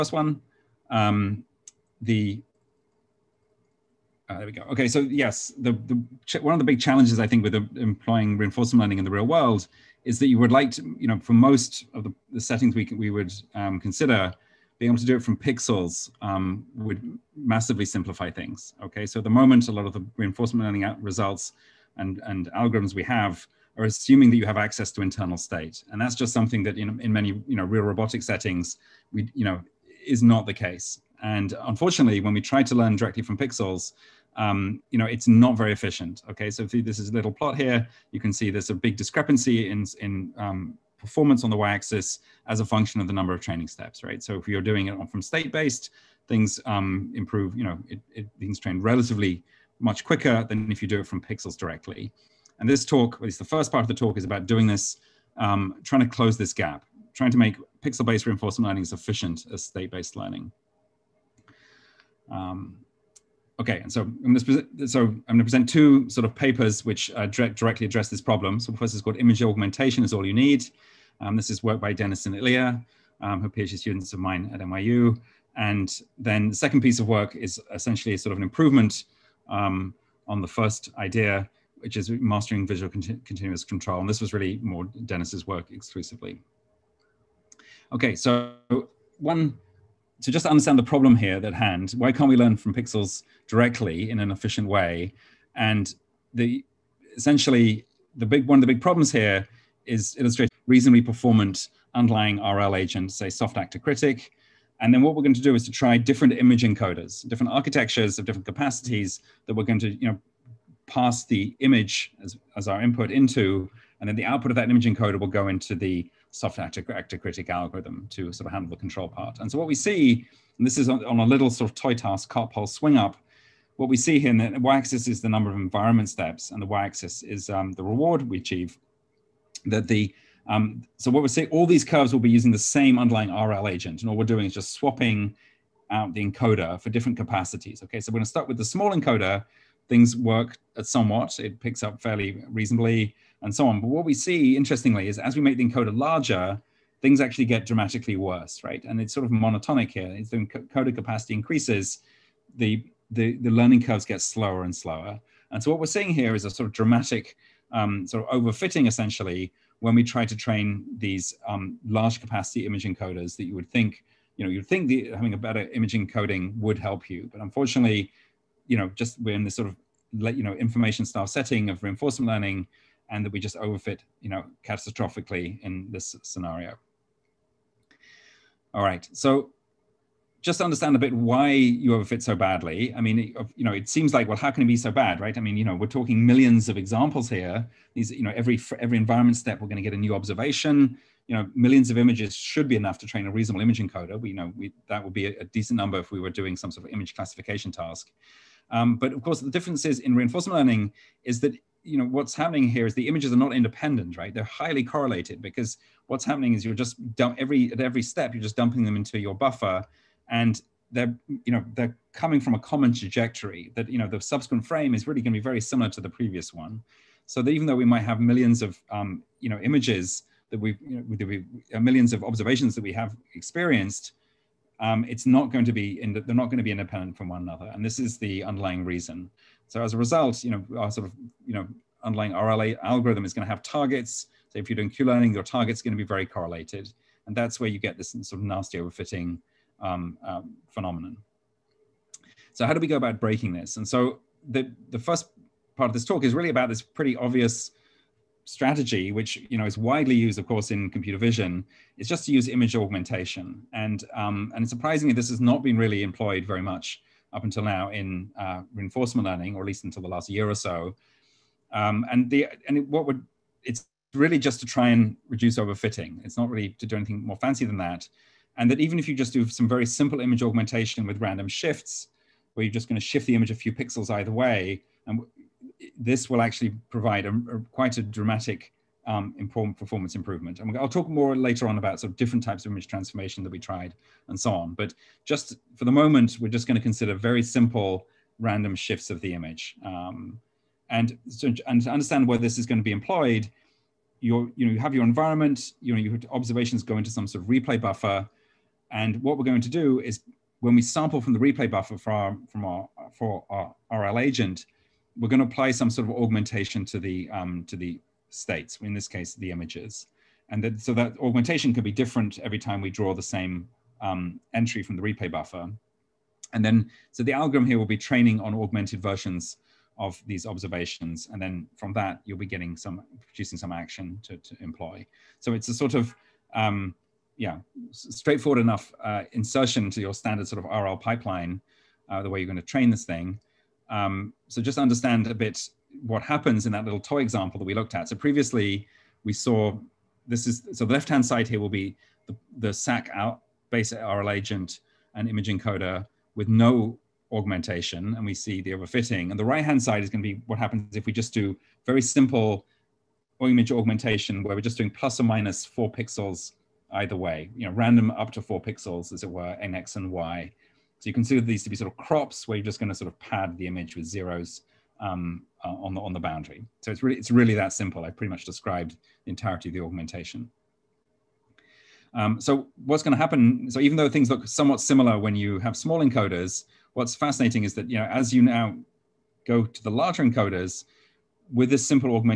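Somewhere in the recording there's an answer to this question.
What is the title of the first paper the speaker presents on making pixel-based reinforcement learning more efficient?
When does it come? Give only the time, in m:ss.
1:09.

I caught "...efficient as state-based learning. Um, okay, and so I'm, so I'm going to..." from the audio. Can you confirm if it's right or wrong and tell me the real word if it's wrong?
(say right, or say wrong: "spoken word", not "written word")
right.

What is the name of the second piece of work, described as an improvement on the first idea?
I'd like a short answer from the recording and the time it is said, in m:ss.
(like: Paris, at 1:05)
Mastering visual continuous control, at 1:22.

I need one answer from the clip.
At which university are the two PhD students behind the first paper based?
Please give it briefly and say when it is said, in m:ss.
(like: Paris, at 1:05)
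NYU, at 1:14.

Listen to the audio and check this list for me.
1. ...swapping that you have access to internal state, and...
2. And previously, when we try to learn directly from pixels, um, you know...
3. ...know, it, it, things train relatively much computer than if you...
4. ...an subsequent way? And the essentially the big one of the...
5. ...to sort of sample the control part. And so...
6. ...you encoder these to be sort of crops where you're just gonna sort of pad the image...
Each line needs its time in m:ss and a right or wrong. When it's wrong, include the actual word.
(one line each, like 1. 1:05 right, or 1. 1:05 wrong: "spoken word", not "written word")
1. 0:23 wrong: "assuming", not "swapping"
2. 0:31 wrong: "unfortunately", not "previously"
3. 0:47 wrong: "quicker", not "computer"
4. 1:34 wrong: "efficient", not "subsequent"
5. 1:58 wrong: "handle", not "sample"
6. 6:01 wrong: "consider", not "encoder".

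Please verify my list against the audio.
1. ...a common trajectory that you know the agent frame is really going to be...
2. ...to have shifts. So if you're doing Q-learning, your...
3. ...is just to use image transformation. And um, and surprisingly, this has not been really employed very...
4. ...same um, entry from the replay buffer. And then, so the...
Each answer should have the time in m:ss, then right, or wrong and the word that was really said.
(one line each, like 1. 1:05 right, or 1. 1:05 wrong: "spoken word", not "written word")
1. 3:32 wrong: "subsequent", not "agent"
2. 3:53 wrong: "targets", not "shifts"
3. 4:11 wrong: "augmentation", not "transformation"
4. 5:13 right.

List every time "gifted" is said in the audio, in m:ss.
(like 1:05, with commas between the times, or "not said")
not said.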